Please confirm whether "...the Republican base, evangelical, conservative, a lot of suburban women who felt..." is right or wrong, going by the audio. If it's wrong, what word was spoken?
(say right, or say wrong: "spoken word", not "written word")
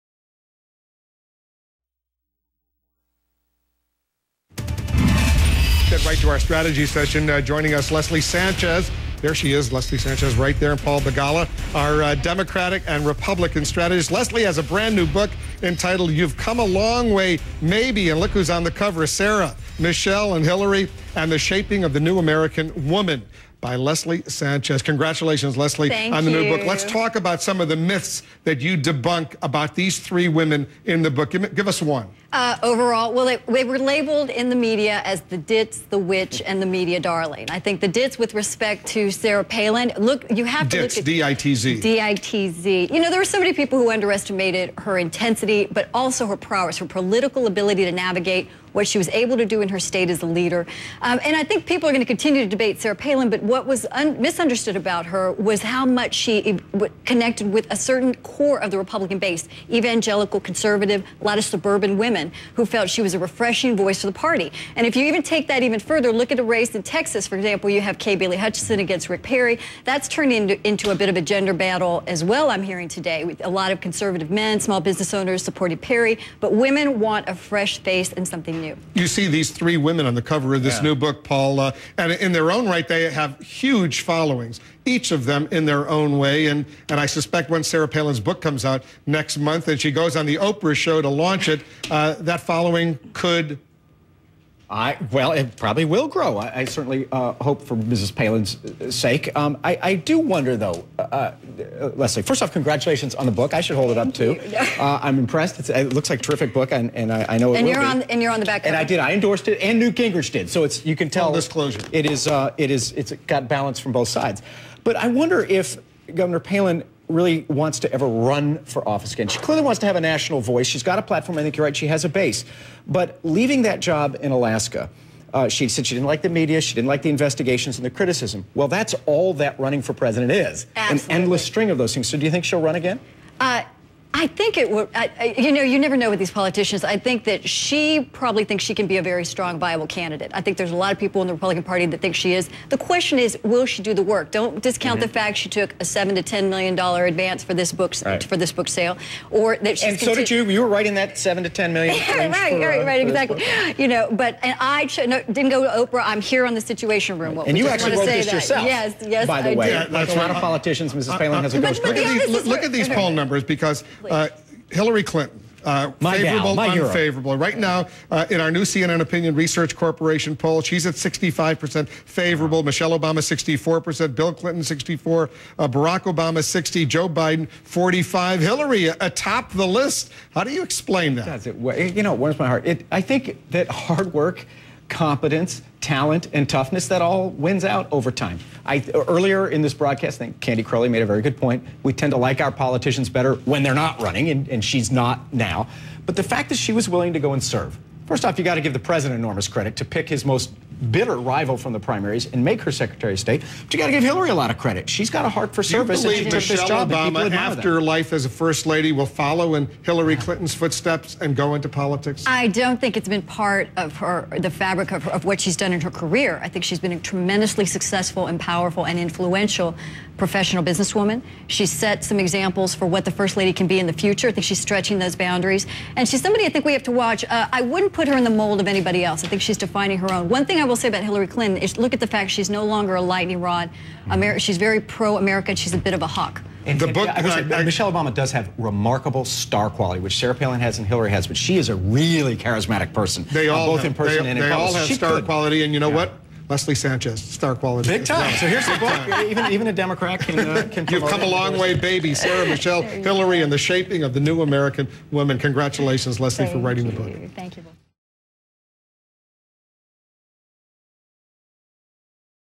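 right.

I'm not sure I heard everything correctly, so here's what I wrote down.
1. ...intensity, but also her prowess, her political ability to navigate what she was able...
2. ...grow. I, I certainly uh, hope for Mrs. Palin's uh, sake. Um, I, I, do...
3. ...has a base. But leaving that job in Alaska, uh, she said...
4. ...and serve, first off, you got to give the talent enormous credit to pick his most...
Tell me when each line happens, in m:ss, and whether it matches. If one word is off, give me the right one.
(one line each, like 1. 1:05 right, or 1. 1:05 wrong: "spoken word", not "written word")
1. 0:44 right
2. 1:36 right
3. 2:01 right
4. 3:17 wrong: "president", not "talent".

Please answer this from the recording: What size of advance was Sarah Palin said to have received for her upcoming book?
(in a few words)
$7 to 10 million.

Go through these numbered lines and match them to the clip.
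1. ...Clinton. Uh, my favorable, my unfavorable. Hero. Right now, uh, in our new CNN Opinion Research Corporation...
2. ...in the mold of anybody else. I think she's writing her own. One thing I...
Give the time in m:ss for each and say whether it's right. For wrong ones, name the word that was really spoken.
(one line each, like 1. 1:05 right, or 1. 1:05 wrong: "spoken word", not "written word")
1. 2:45 right
2. 3:48 wrong: "defining", not "writing".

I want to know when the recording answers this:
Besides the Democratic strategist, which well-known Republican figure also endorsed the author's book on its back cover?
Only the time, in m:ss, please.
1:49.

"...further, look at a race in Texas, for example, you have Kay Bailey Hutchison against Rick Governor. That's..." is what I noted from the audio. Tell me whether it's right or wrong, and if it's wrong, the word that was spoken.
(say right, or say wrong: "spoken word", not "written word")
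wrong: "Perry", not "Governor".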